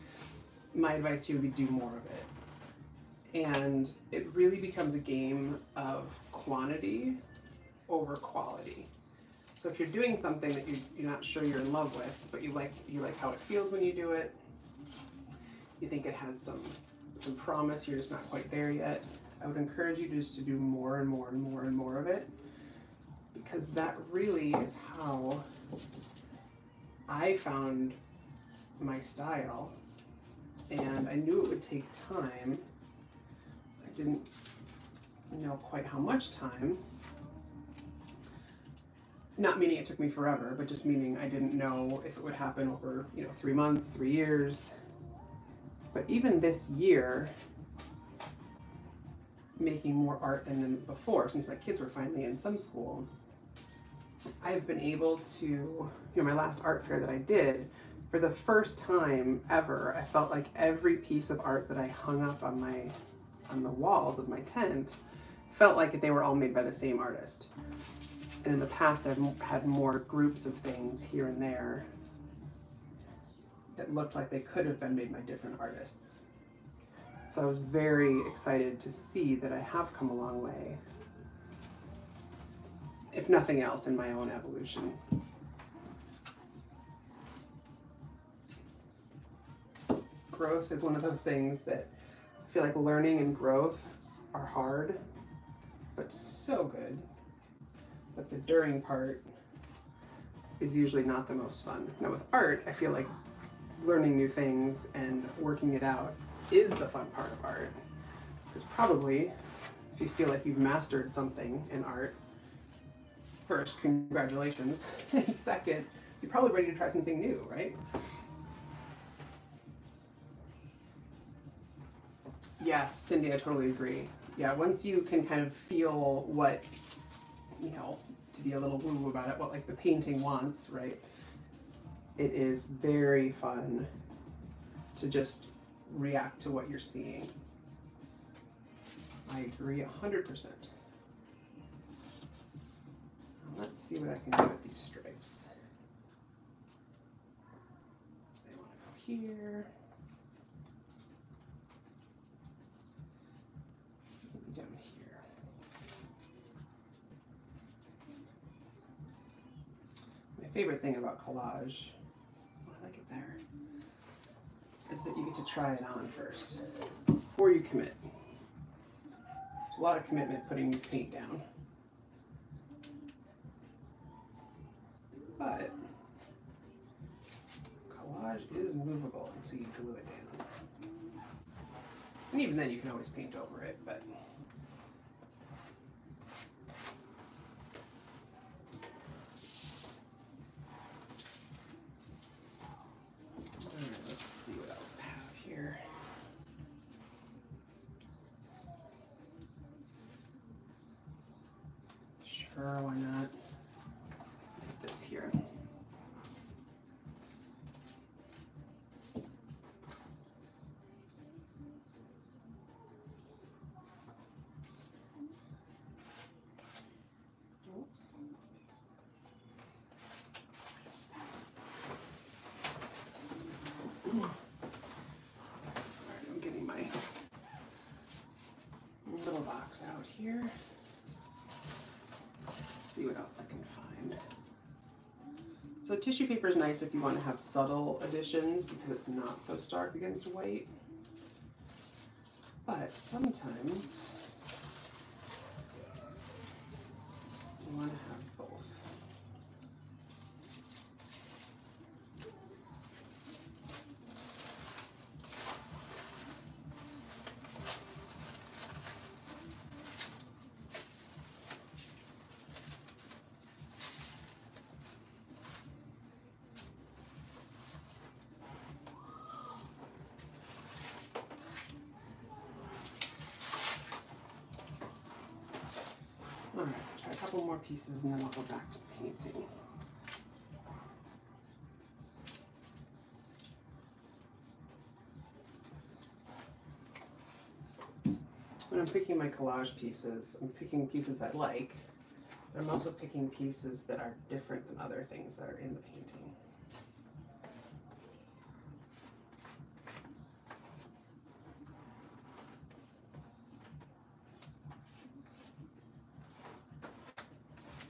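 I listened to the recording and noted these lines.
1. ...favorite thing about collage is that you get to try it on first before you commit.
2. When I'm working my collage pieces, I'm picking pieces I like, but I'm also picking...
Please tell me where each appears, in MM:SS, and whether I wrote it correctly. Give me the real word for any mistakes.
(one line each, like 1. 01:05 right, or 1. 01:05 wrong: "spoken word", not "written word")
1. 02:40 right
2. 04:48 wrong: "picking", not "working".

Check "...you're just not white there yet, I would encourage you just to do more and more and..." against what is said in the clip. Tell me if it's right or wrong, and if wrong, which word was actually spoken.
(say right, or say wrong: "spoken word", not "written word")
wrong: "quite", not "white".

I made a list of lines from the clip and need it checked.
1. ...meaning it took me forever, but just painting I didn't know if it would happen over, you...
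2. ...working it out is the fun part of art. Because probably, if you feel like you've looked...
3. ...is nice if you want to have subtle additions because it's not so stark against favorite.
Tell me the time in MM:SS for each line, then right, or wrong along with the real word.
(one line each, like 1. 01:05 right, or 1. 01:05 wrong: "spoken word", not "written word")
1. 00:39 wrong: "meaning", not "painting"
2. 01:45 wrong: "mastered", not "looked"
3. 03:56 wrong: "white", not "favorite".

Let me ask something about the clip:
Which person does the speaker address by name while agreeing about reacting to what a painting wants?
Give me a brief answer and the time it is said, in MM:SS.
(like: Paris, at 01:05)
Cindy, at 02:02.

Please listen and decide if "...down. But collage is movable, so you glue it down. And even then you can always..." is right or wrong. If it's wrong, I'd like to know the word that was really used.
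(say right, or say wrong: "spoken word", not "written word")
right.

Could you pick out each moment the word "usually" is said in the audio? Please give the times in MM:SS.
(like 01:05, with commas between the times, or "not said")
01:40.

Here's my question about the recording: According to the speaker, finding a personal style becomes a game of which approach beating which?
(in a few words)
quantity over quality.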